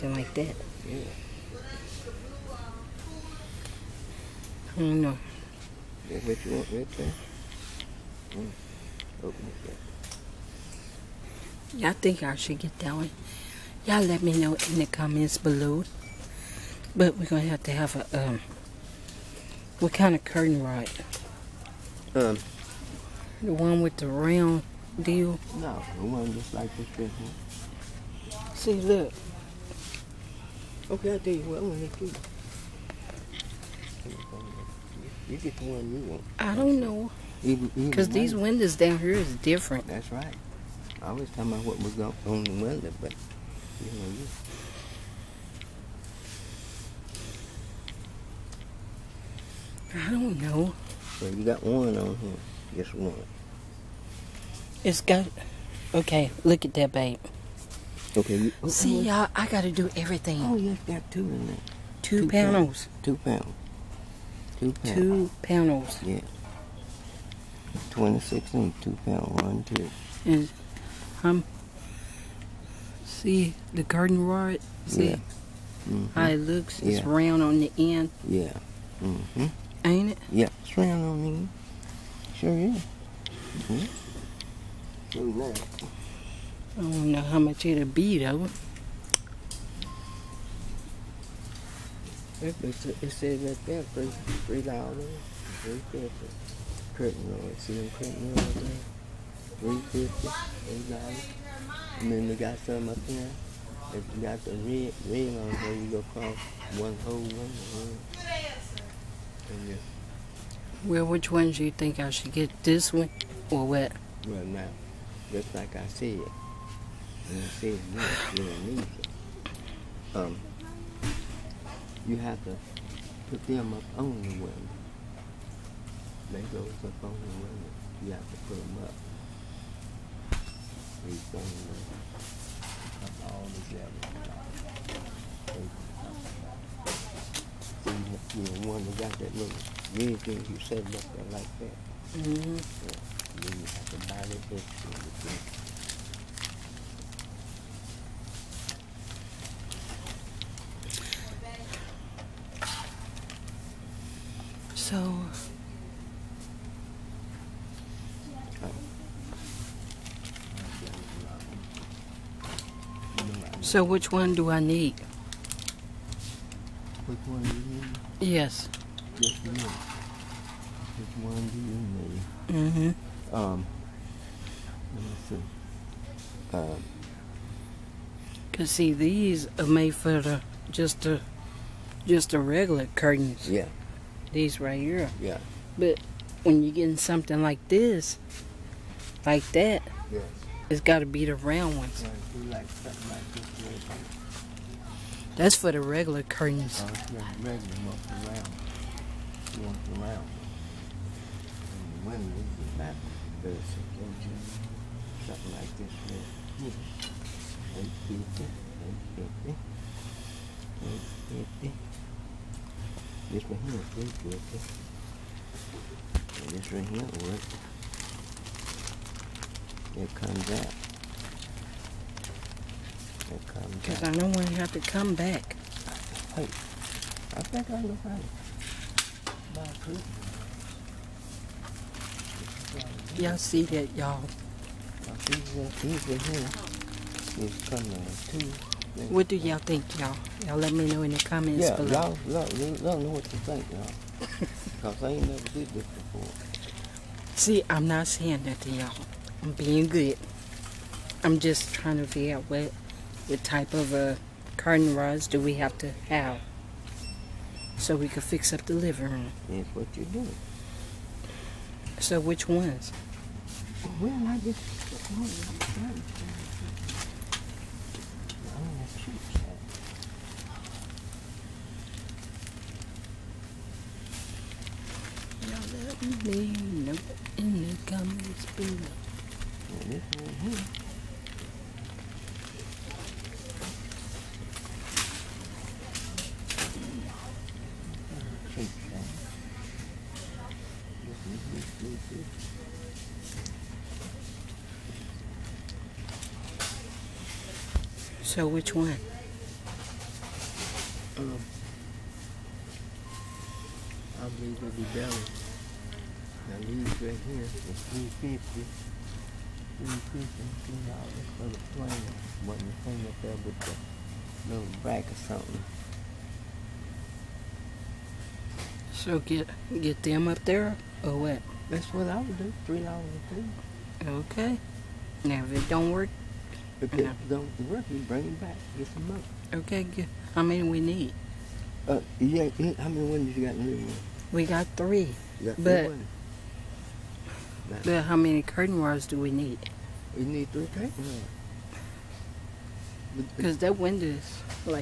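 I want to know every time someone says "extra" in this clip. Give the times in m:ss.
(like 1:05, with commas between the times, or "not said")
2:24.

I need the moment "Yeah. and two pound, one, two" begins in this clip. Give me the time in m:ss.
1:06.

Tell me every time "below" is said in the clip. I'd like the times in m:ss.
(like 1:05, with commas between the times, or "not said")
0:15, 4:01, 4:38.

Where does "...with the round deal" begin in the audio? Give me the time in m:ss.
0:23.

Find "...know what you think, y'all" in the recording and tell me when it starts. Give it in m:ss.
4:02.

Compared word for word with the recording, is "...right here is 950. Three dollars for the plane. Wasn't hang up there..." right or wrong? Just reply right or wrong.
wrong.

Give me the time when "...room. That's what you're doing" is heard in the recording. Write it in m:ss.
4:19.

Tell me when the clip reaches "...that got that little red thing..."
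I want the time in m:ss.
2:18.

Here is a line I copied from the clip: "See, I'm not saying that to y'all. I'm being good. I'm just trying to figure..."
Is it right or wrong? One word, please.
right.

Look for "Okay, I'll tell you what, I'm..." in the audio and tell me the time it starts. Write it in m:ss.
0:30.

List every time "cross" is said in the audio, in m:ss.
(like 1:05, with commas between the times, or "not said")
1:46.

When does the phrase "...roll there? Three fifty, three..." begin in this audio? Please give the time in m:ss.
1:38.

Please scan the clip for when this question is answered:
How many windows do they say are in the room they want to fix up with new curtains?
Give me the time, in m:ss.
5:34.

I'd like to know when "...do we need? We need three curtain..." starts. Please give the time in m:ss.
5:39.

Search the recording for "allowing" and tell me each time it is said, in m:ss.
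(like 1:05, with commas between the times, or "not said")
not said.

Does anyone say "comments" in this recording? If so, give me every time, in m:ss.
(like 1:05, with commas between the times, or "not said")
0:14, 4:01, 4:37.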